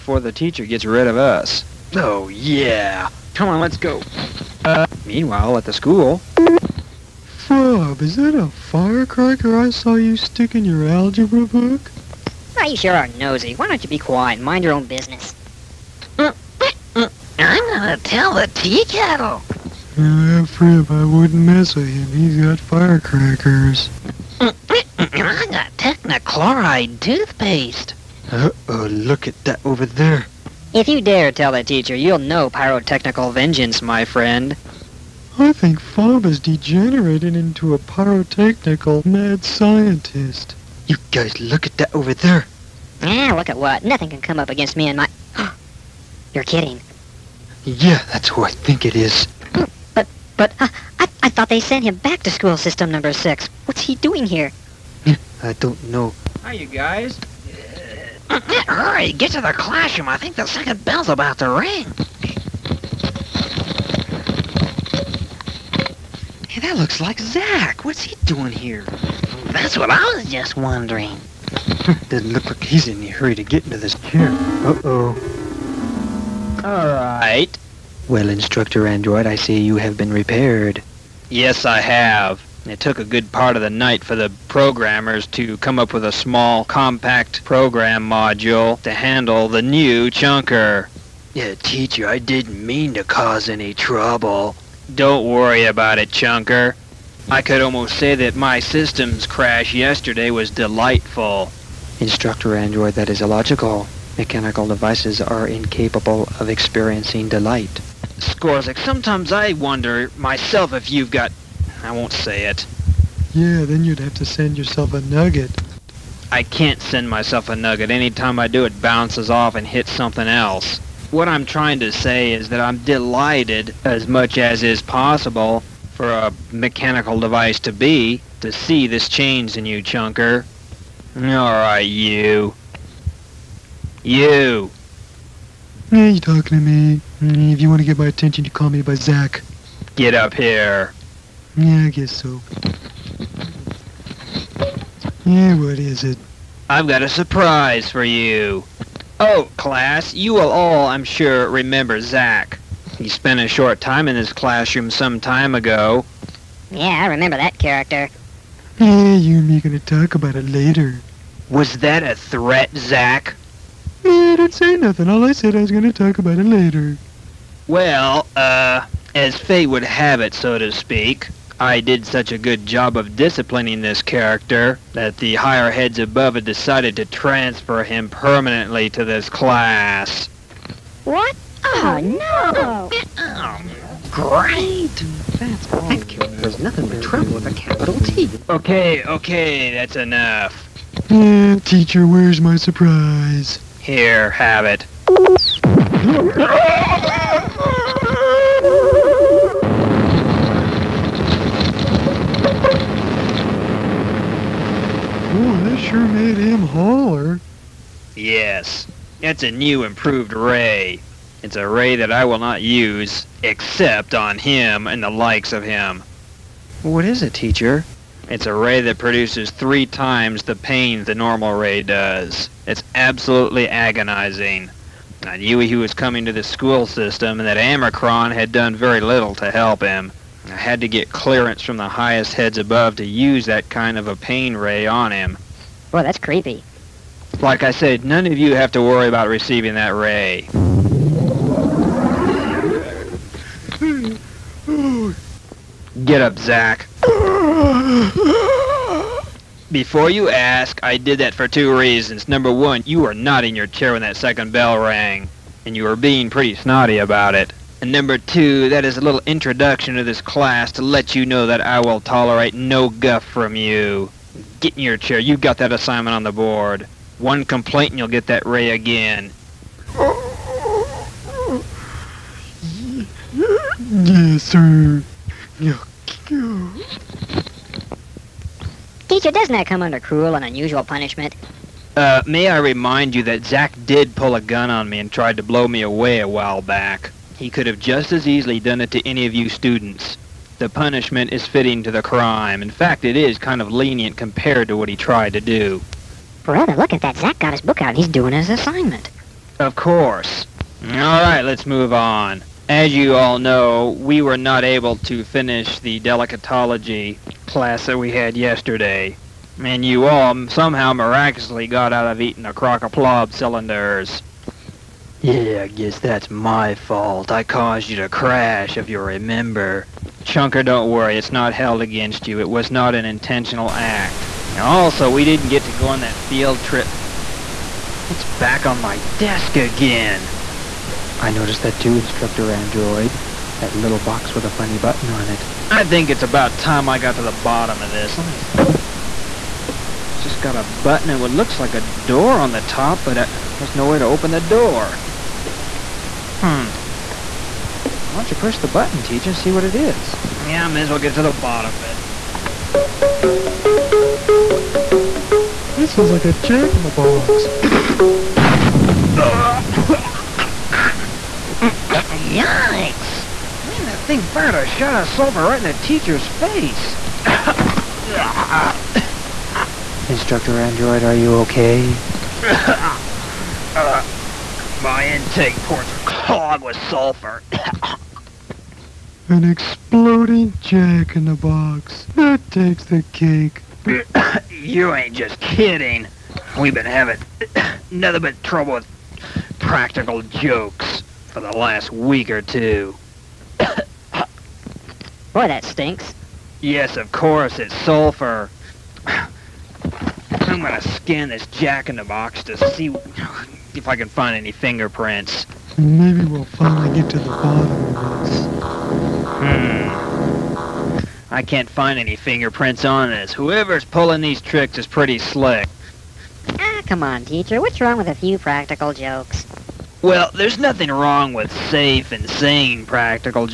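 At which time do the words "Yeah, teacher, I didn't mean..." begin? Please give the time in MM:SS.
01:31.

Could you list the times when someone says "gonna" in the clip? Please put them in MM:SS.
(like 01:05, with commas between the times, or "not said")
00:17, 02:39, 02:45, 06:40.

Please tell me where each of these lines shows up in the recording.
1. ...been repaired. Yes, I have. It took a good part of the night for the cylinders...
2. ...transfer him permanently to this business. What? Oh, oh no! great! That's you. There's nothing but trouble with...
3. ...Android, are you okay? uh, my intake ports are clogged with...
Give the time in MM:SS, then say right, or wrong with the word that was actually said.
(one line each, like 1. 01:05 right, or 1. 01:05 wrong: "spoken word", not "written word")
1. 01:19 wrong: "programmers", not "cylinders"
2. 02:57 wrong: "class", not "business"
3. 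06:10 right.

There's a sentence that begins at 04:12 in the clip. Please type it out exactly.
Number one, you were not in your chair when that second bell rang, and you were being pretty snotty about it.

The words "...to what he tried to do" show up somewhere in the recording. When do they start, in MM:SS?
04:54.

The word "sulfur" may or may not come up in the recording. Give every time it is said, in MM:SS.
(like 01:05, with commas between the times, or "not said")
06:05, 06:16, 06:37.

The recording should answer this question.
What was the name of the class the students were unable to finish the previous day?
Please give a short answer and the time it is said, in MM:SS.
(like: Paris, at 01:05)
Delicatology, at 05:06.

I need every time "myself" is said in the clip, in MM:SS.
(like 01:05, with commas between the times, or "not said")
01:50, 01:57.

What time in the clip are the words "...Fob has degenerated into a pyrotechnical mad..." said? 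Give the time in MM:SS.
00:35.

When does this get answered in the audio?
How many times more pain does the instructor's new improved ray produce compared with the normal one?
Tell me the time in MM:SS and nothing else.
03:39.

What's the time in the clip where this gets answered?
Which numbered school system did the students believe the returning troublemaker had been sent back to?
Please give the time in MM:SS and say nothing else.
00:52.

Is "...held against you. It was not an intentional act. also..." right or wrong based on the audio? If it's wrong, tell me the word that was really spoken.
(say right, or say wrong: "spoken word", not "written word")
right.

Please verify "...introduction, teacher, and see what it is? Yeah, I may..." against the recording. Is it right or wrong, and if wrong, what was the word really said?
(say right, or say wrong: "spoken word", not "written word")
wrong: "button", not "introduction".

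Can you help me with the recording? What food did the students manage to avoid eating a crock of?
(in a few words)
Plob cylinders.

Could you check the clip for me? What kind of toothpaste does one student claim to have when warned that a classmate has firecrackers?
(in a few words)
Technochloride toothpaste.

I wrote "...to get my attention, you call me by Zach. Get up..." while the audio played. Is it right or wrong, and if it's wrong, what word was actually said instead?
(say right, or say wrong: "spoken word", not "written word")
right.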